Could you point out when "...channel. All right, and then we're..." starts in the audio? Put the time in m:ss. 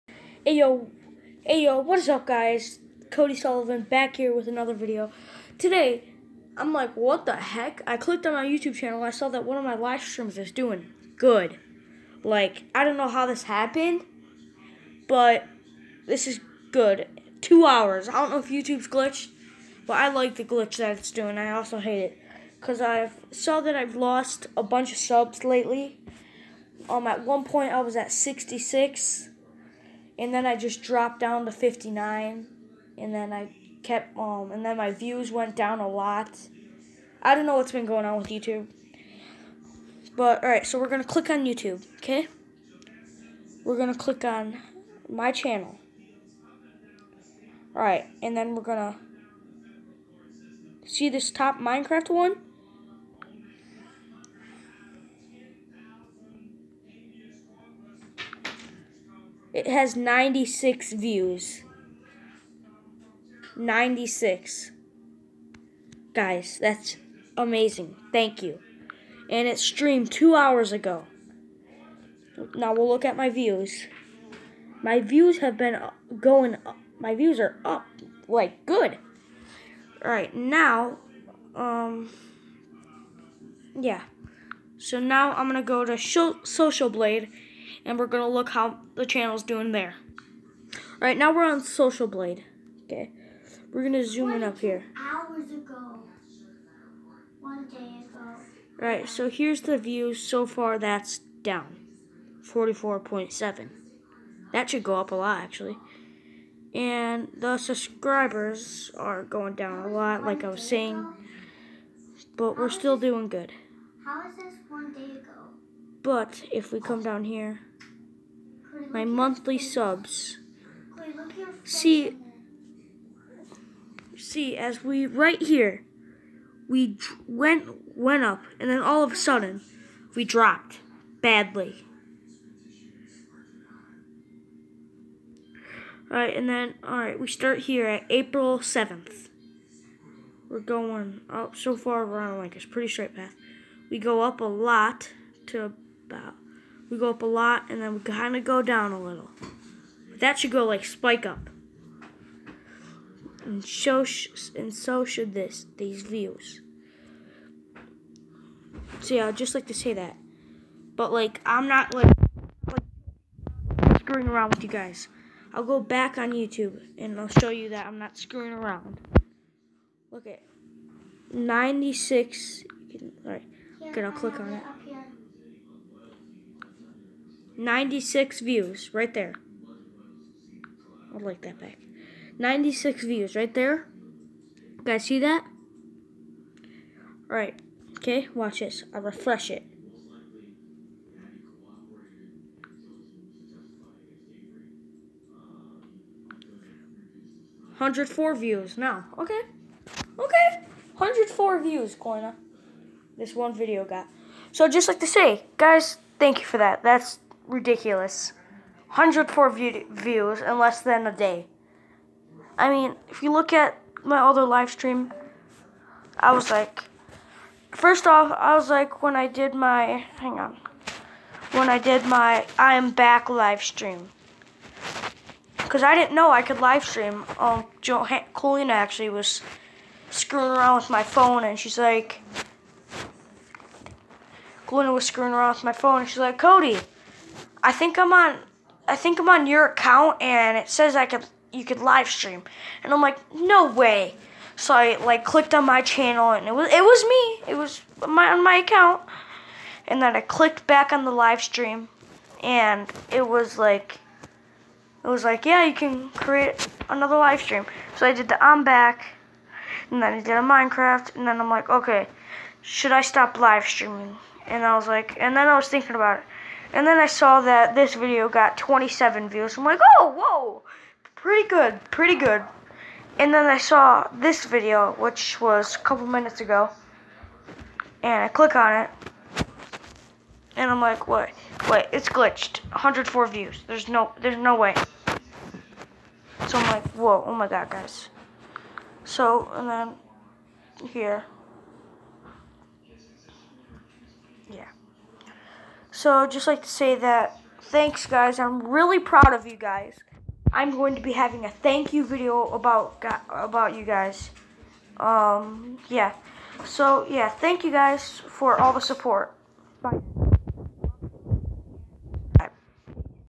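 0:45.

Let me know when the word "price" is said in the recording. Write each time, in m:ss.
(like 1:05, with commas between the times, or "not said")
not said.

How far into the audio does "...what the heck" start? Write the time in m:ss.
0:06.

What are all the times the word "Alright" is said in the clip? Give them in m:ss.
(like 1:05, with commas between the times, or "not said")
1:20, 3:07.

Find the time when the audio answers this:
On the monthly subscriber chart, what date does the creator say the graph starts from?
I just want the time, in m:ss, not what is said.
2:18.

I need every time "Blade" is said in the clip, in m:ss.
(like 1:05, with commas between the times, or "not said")
1:26, 1:32.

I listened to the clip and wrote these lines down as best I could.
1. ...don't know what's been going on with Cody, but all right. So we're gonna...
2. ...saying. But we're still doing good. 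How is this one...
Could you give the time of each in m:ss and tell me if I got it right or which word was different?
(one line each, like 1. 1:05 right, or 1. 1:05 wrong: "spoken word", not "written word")
1. 0:37 wrong: "YouTube", not "Cody"
2. 1:50 right.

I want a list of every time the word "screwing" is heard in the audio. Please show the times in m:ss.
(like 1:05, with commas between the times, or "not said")
2:43, 2:48, 3:50, 3:55.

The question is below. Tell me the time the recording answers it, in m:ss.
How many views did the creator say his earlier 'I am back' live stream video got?
4:28.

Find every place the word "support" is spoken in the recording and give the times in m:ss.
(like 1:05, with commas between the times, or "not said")
5:08.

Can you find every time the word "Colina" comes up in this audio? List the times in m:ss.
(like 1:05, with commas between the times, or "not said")
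3:48, 3:54.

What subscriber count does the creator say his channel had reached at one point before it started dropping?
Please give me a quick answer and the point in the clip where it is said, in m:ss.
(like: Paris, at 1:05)
66, at 0:28.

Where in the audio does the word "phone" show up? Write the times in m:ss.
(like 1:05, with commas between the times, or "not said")
3:51, 3:55.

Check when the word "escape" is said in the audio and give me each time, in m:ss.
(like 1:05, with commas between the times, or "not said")
not said.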